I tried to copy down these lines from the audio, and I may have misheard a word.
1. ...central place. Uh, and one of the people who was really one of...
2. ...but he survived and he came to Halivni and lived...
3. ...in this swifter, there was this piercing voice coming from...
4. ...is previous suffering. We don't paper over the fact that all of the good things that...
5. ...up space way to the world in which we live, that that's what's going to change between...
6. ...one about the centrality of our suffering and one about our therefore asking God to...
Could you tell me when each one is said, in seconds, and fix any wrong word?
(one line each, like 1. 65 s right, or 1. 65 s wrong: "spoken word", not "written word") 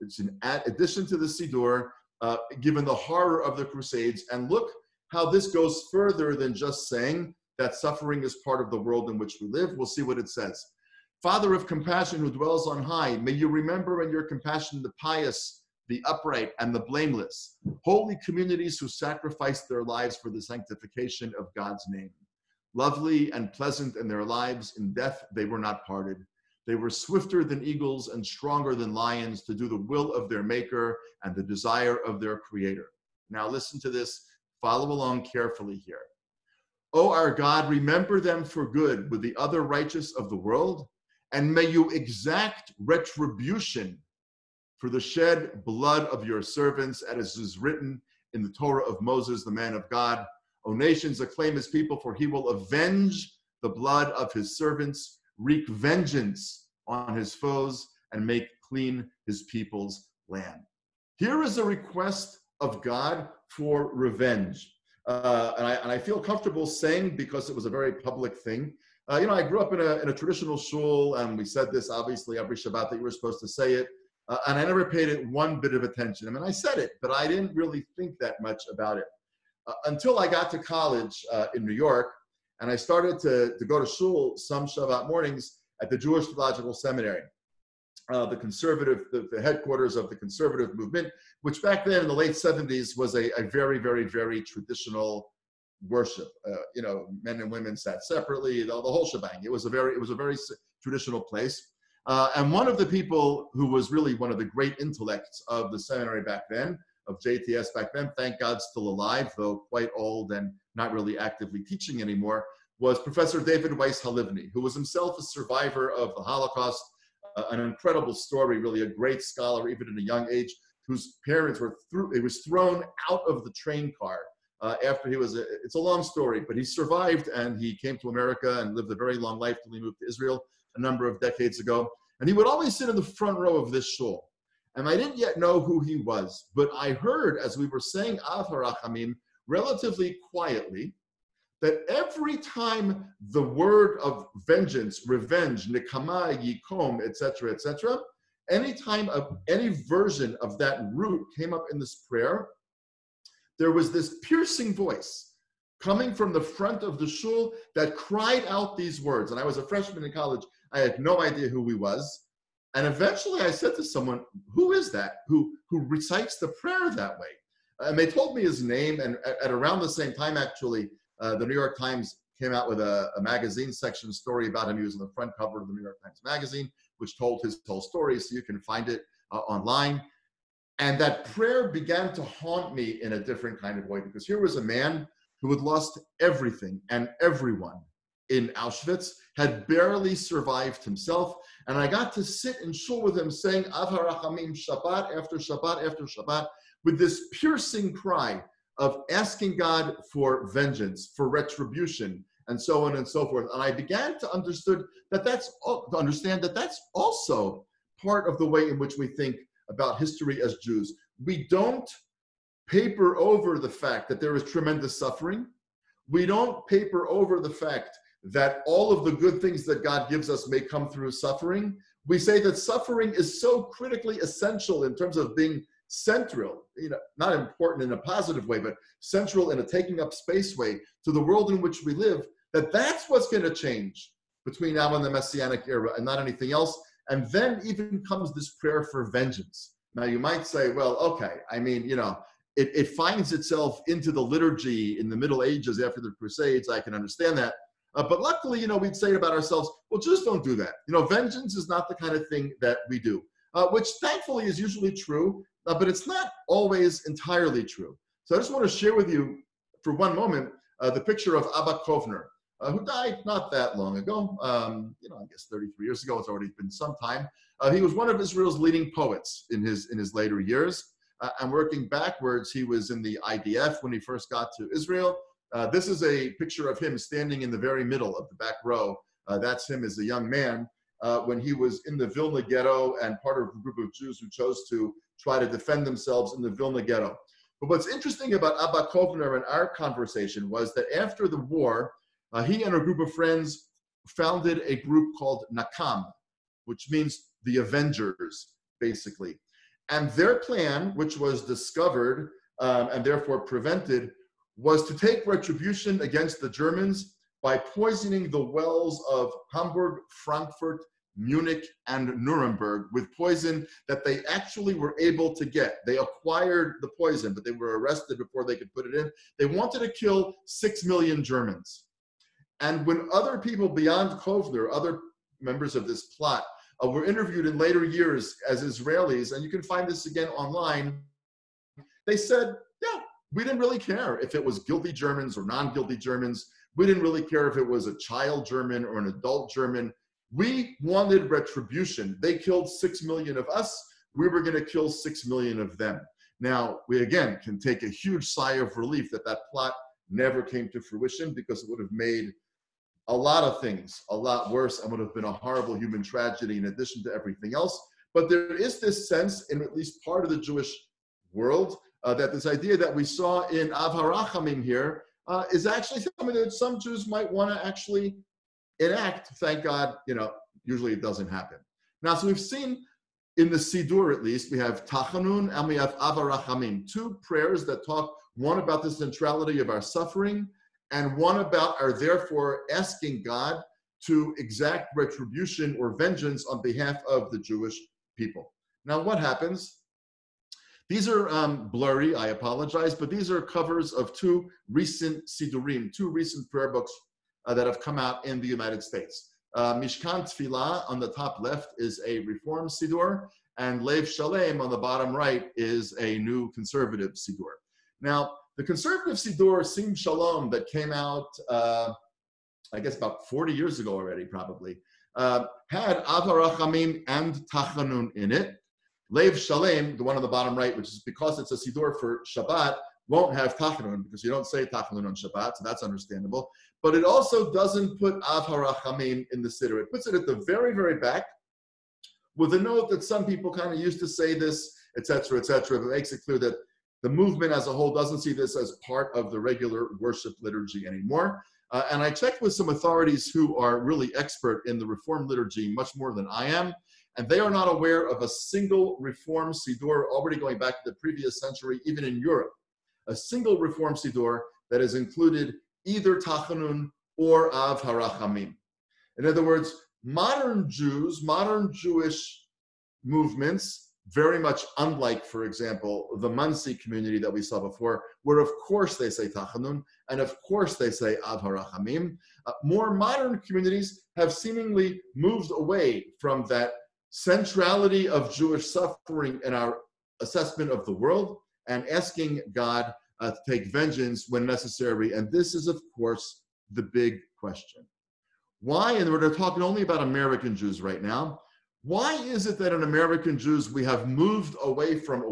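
1. 100 s wrong: "traditional", not "central"
2. 126 s wrong: "America", not "Halivni"
3. 151 s wrong: "prayer", not "swifter"
4. 214 s wrong: "tremendous", not "previous"
5. 229 s right
6. 378 s right.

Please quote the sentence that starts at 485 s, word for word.
And this is, of course, the big question.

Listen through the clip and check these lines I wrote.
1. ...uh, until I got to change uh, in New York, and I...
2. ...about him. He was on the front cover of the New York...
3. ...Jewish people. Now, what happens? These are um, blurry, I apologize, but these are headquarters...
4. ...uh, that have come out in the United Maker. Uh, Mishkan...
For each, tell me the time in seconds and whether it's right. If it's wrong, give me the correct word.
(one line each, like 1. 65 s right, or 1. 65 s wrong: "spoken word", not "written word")
1. 79 s wrong: "college", not "change"
2. 174 s right
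3. 387 s wrong: "covers", not "headquarters"
4. 397 s wrong: "States", not "Maker".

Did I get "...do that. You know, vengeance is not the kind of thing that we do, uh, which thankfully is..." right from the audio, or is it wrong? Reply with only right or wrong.
right.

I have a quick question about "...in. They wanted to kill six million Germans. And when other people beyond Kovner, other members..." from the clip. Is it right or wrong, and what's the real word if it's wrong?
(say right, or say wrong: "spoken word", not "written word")
right.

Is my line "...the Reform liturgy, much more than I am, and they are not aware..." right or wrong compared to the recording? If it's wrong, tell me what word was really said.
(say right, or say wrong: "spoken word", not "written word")
right.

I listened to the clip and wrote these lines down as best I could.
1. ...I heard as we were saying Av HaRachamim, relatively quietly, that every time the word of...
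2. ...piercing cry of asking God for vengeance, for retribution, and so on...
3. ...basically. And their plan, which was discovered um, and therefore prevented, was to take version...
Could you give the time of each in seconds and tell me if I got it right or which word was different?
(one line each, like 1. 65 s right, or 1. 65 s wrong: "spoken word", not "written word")
1. 136 s right
2. 197 s right
3. 298 s wrong: "retribution", not "version".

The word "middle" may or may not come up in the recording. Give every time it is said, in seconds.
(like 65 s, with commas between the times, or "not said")
245 s, 277 s.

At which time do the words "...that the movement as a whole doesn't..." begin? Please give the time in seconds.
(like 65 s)
436 s.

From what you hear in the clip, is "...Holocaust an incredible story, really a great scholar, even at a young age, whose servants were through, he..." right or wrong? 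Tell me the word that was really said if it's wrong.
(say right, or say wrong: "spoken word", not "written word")
wrong: "parents", not "servants".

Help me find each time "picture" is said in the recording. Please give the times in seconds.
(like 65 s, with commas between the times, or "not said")
261 s, 276 s.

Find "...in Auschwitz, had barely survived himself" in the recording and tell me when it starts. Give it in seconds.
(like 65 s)
188 s.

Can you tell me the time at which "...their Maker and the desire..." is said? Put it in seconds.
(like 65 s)
30 s.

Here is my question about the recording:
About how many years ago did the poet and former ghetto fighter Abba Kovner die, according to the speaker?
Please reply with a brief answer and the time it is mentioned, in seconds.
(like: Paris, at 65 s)
33, at 265 s.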